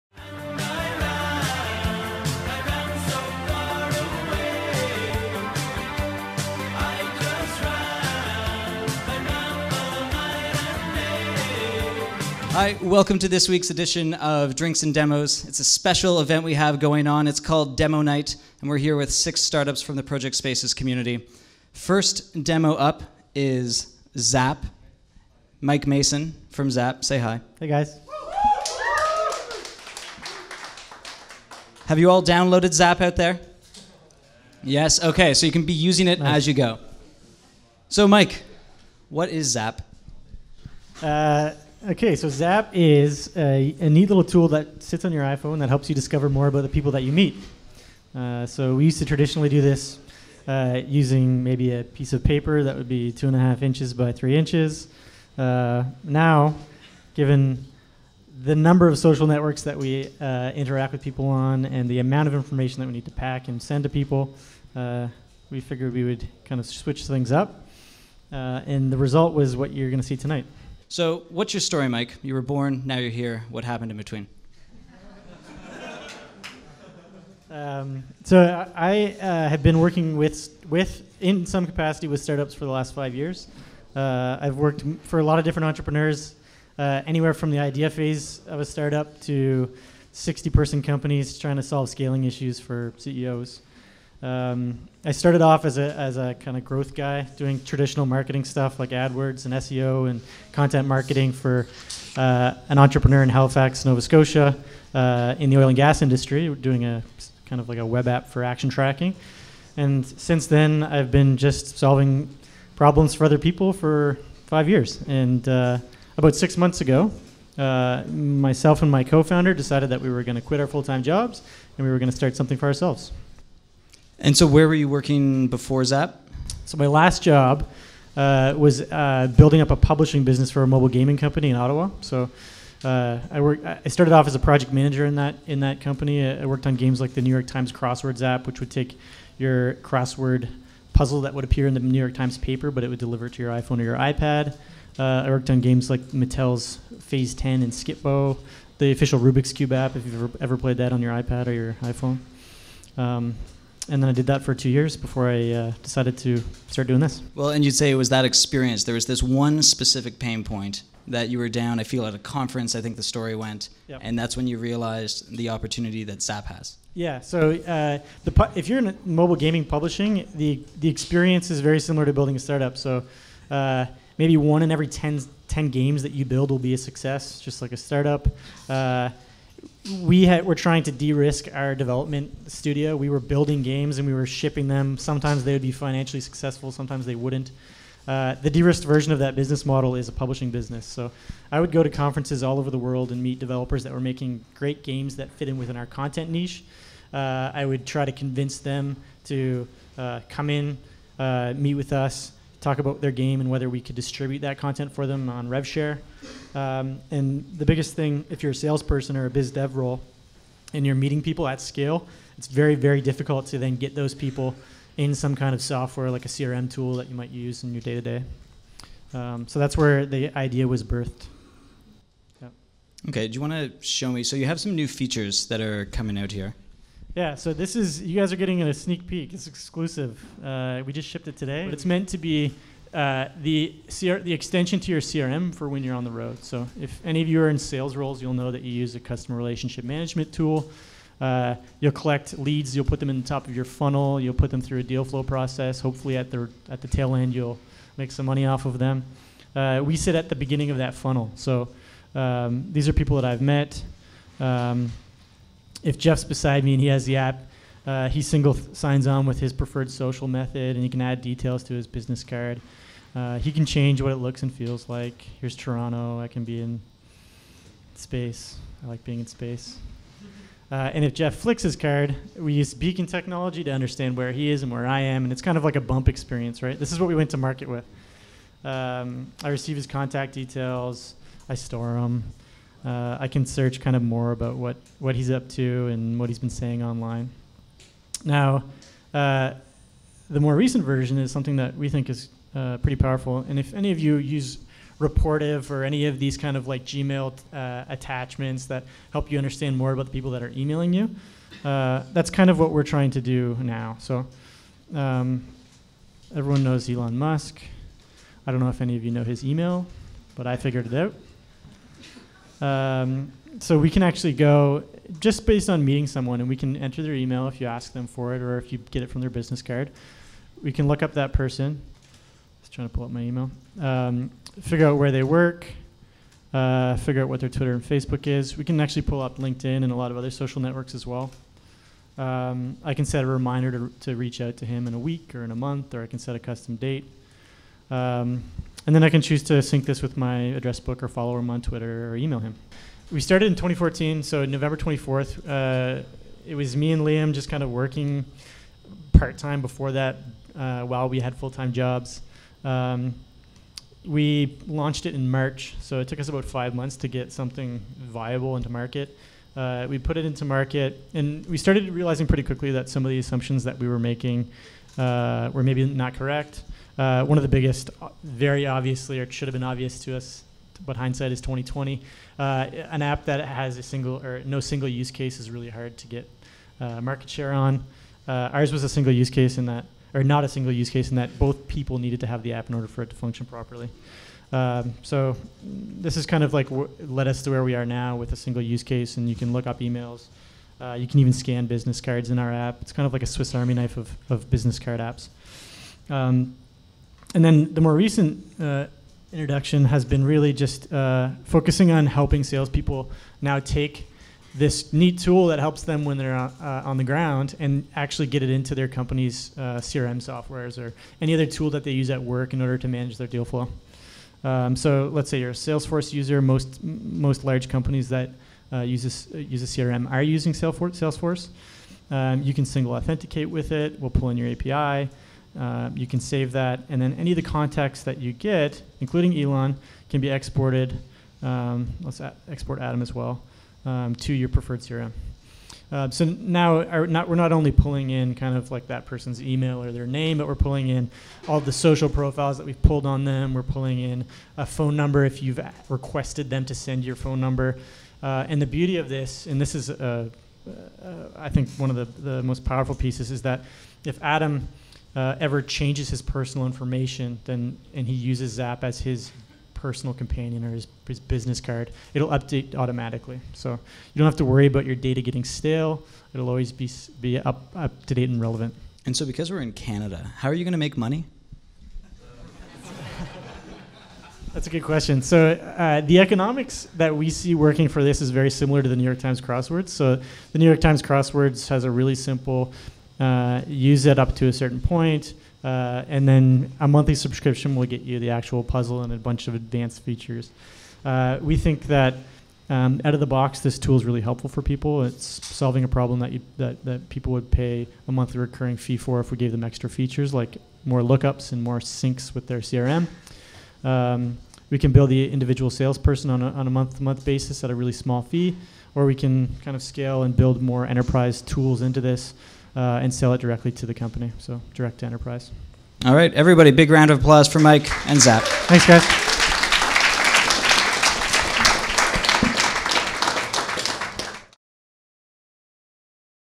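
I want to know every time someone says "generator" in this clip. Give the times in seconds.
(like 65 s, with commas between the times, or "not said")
not said.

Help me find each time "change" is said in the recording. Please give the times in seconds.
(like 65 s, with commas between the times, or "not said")
263 s, 455 s.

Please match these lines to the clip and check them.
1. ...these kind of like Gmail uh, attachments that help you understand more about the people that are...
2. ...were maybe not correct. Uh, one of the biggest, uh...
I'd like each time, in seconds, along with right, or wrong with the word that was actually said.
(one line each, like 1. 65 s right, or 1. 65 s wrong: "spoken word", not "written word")
1. 296 s right
2. 365 s right.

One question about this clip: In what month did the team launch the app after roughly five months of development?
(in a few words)
March.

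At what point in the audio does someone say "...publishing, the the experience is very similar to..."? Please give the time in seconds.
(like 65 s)
169 s.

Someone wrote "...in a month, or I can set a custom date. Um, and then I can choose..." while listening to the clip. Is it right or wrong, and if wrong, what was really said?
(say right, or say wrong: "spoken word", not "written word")
right.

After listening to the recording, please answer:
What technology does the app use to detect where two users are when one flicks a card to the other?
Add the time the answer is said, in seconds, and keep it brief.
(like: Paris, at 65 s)
beacon technology, at 272 s.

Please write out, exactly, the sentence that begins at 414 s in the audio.
Um, so let's say you're a Salesforce user.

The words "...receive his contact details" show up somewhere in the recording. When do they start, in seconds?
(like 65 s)
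279 s.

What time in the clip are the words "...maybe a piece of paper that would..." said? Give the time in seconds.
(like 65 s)
51 s.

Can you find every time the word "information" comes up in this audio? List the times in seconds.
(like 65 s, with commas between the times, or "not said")
62 s, 456 s.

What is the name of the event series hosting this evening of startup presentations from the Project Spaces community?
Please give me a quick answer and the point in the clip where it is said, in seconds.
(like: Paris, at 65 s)
Drinks and Demos, at 14 s.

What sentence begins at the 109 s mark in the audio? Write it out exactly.
And since then, I've been just solving problems for other people for five years.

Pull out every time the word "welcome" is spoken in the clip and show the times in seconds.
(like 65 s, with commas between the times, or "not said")
12 s.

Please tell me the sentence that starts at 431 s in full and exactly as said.
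Um, let's export Adam as well um, to your preferred CRM.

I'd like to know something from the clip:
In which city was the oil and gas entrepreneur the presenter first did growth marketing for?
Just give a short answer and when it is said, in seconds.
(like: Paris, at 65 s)
Halifax, at 103 s.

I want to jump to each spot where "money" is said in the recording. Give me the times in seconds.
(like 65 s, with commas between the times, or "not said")
248 s, 470 s.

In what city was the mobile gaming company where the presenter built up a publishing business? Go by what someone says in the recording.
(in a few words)
Ottawa.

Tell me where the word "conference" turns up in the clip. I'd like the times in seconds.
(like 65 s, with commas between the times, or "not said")
162 s, 191 s.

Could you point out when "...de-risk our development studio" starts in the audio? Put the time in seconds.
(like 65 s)
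180 s.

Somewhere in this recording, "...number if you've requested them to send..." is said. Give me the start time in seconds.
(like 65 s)
444 s.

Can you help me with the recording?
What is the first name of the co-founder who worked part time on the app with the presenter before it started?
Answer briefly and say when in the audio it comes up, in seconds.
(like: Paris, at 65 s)
Liam, at 347 s.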